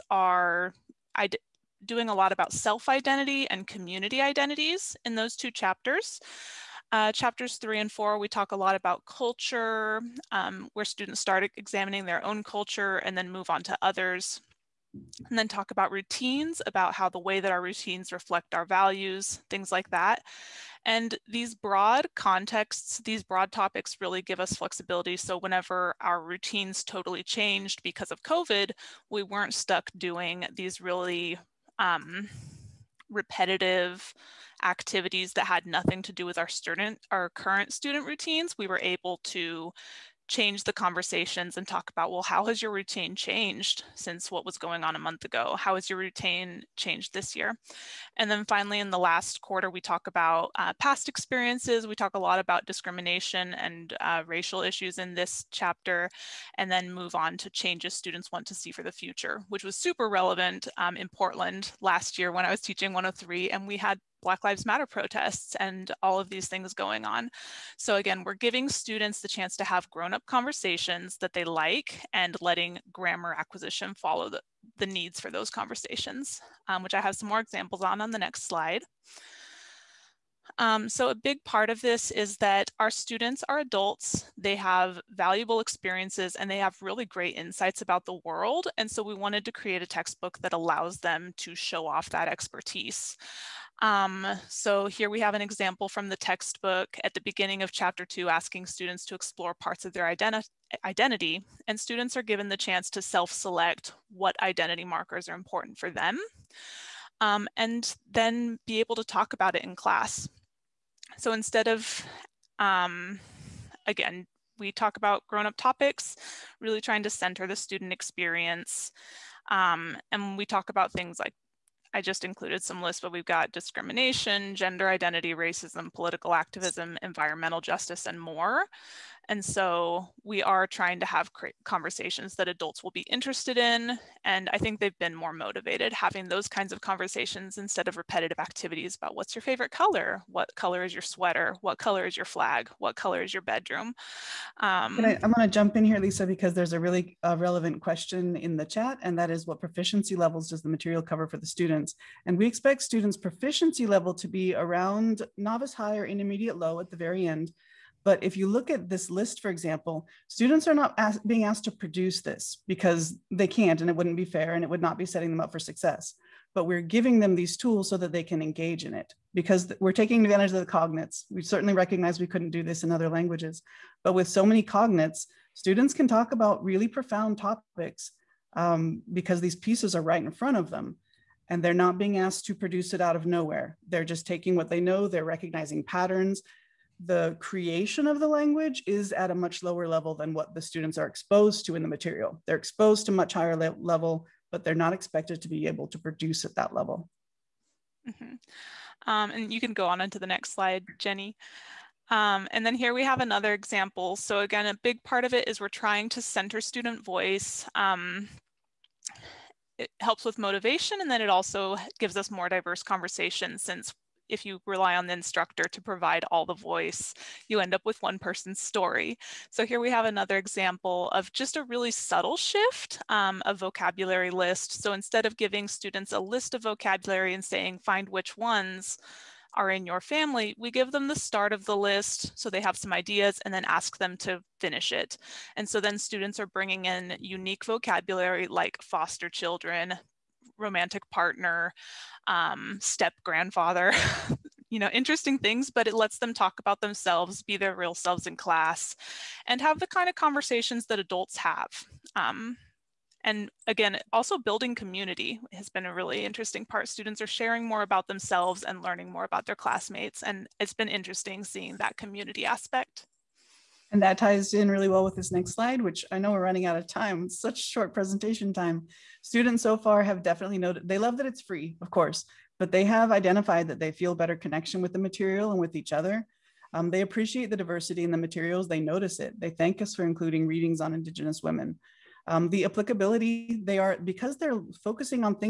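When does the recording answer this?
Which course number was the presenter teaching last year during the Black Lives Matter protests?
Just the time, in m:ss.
1:02.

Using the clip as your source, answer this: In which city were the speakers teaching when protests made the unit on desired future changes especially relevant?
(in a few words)
Portland.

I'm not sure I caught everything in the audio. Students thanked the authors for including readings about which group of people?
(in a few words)
Indigenous women.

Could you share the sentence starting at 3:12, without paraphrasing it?
They're exposed to much higher le level, but they're not expected to be able to produce at that level.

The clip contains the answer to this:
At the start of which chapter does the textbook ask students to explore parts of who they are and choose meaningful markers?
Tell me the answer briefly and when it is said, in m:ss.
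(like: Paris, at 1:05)
Chapter two, at 1:37.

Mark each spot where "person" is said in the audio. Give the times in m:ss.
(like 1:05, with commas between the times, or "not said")
3:38.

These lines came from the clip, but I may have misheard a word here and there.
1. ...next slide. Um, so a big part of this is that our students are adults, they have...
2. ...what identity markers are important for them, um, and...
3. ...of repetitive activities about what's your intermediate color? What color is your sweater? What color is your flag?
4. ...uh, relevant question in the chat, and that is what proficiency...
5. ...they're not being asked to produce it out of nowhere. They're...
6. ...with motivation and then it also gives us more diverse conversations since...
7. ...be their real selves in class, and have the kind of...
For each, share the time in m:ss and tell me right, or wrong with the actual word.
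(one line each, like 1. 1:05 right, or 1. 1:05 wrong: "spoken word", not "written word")
1. 1:18 right
2. 1:44 right
3. 2:17 wrong: "favorite", not "intermediate"
4. 2:27 right
5. 3:01 right
6. 3:30 right
7. 4:07 right.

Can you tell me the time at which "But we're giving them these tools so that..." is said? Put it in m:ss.
2:46.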